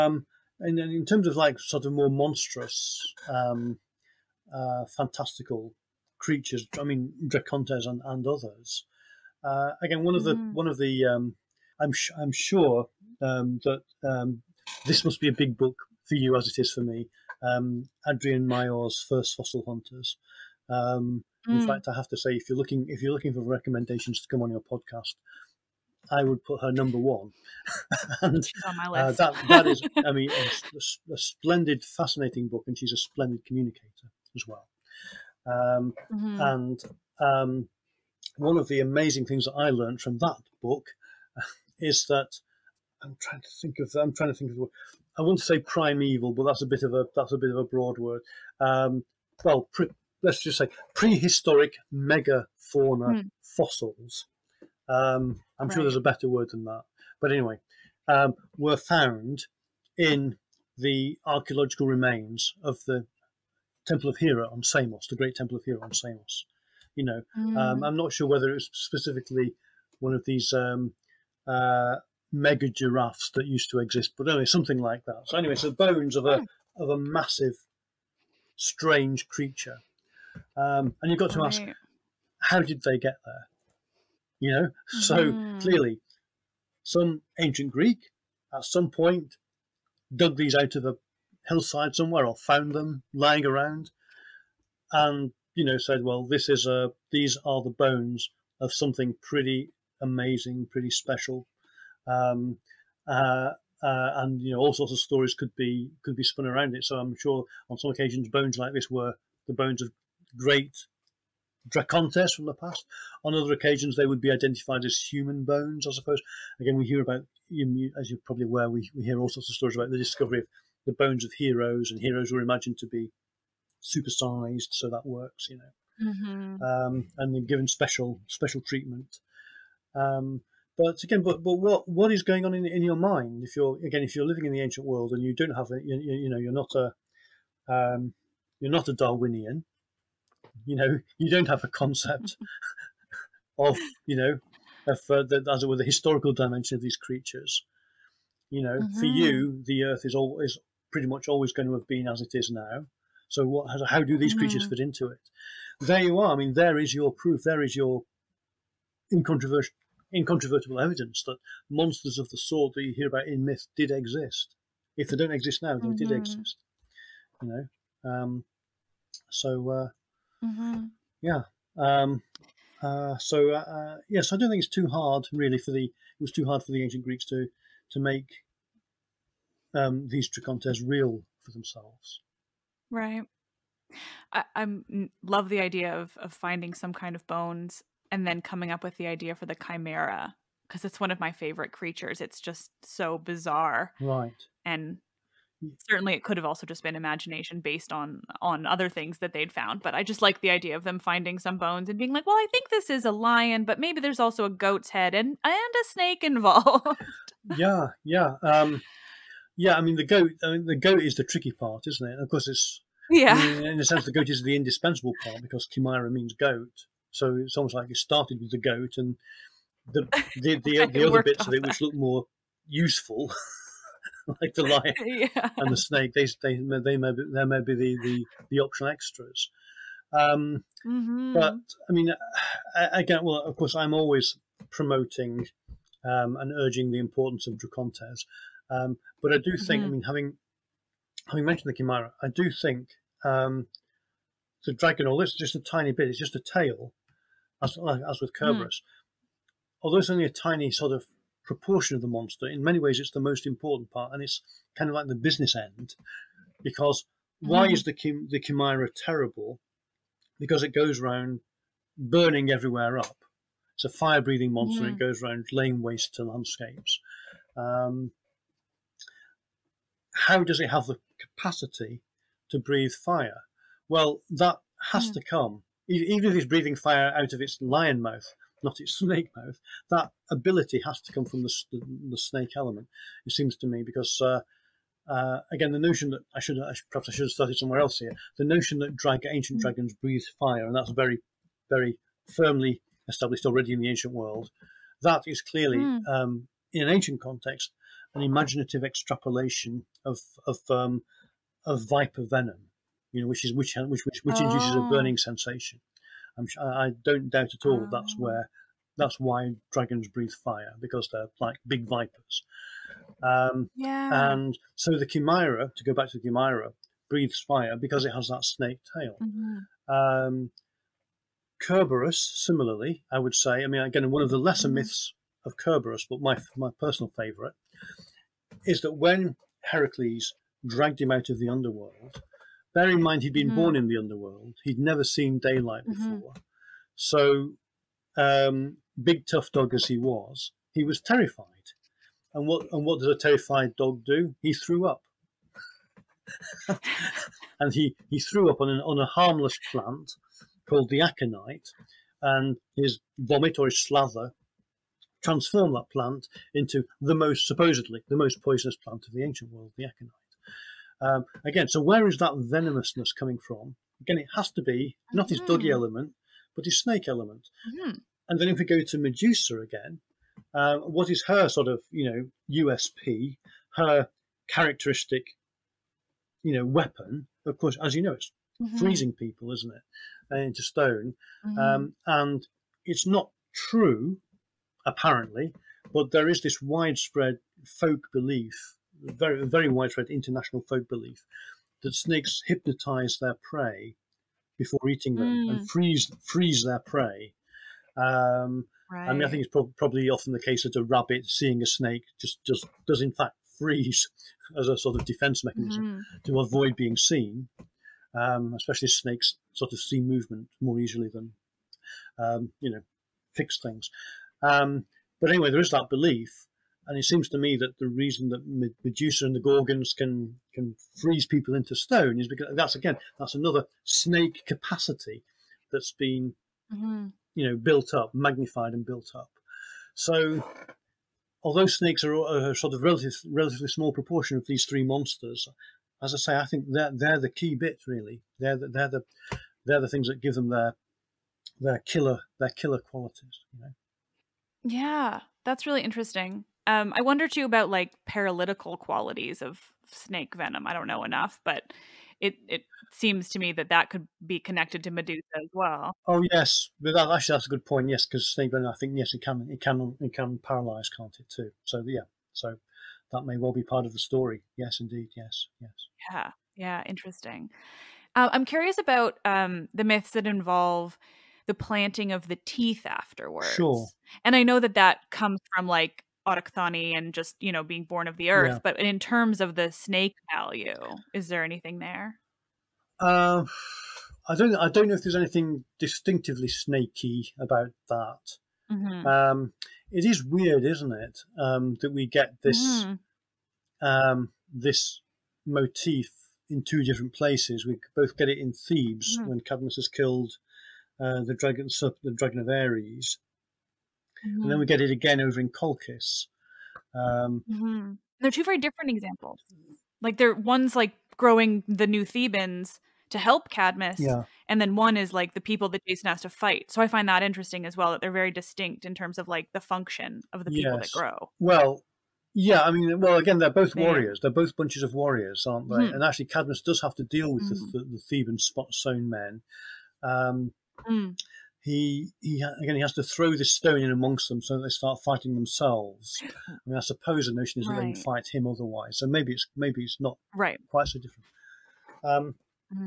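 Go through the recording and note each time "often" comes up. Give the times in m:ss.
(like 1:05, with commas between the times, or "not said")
6:40.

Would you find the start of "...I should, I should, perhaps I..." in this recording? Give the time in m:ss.
4:46.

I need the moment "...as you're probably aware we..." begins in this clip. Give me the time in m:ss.
1:57.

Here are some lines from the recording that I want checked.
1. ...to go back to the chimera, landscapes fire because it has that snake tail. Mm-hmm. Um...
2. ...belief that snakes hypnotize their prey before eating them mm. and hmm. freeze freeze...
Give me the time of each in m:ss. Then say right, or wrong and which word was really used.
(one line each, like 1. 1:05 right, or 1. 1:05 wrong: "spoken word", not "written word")
1. 5:15 wrong: "breathes", not "landscapes"
2. 6:30 right.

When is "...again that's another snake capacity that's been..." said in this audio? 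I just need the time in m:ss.
7:02.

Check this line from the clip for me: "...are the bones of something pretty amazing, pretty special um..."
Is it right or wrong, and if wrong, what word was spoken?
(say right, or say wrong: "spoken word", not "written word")
right.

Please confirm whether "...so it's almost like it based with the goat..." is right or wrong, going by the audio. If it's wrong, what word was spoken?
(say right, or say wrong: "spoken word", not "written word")
wrong: "started", not "based".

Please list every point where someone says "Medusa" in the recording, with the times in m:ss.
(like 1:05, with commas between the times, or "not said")
6:08, 6:58, 7:34.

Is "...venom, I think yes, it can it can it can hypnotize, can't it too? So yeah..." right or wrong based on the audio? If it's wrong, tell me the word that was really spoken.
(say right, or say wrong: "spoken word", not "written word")
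wrong: "paralyze", not "hypnotize".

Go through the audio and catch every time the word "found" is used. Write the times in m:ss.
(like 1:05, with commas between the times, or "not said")
0:58, 1:32, 3:19.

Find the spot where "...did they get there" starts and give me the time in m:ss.
1:22.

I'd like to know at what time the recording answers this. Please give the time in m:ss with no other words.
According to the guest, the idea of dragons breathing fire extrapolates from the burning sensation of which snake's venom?
5:01.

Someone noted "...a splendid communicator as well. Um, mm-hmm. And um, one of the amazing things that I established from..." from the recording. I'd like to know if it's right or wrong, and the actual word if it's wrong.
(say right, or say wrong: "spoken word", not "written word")
wrong: "learned", not "established".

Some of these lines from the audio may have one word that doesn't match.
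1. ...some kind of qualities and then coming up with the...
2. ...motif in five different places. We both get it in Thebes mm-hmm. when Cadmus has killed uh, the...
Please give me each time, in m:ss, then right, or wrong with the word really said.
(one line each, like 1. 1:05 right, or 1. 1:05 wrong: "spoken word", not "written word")
1. 3:06 wrong: "bones", not "qualities"
2. 8:15 wrong: "two", not "five".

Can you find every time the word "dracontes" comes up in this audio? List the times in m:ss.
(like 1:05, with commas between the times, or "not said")
0:07, 1:51, 3:00, 3:57.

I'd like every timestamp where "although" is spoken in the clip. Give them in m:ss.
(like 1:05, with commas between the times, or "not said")
4:05, 4:09, 7:11.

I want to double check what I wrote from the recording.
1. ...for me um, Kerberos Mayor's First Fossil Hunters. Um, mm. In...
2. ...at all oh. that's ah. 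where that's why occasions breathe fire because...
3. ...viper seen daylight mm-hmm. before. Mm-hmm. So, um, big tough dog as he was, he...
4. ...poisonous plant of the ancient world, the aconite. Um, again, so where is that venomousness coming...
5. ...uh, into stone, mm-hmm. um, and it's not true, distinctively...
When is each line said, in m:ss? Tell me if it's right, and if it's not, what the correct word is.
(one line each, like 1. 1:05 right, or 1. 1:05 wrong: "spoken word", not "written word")
1. 0:16 wrong: "Adrienne", not "Kerberos"
2. 5:07 wrong: "dragons", not "occasions"
3. 5:34 wrong: "never", not "viper"
4. 5:58 right
5. 6:20 wrong: "apparently", not "distinctively".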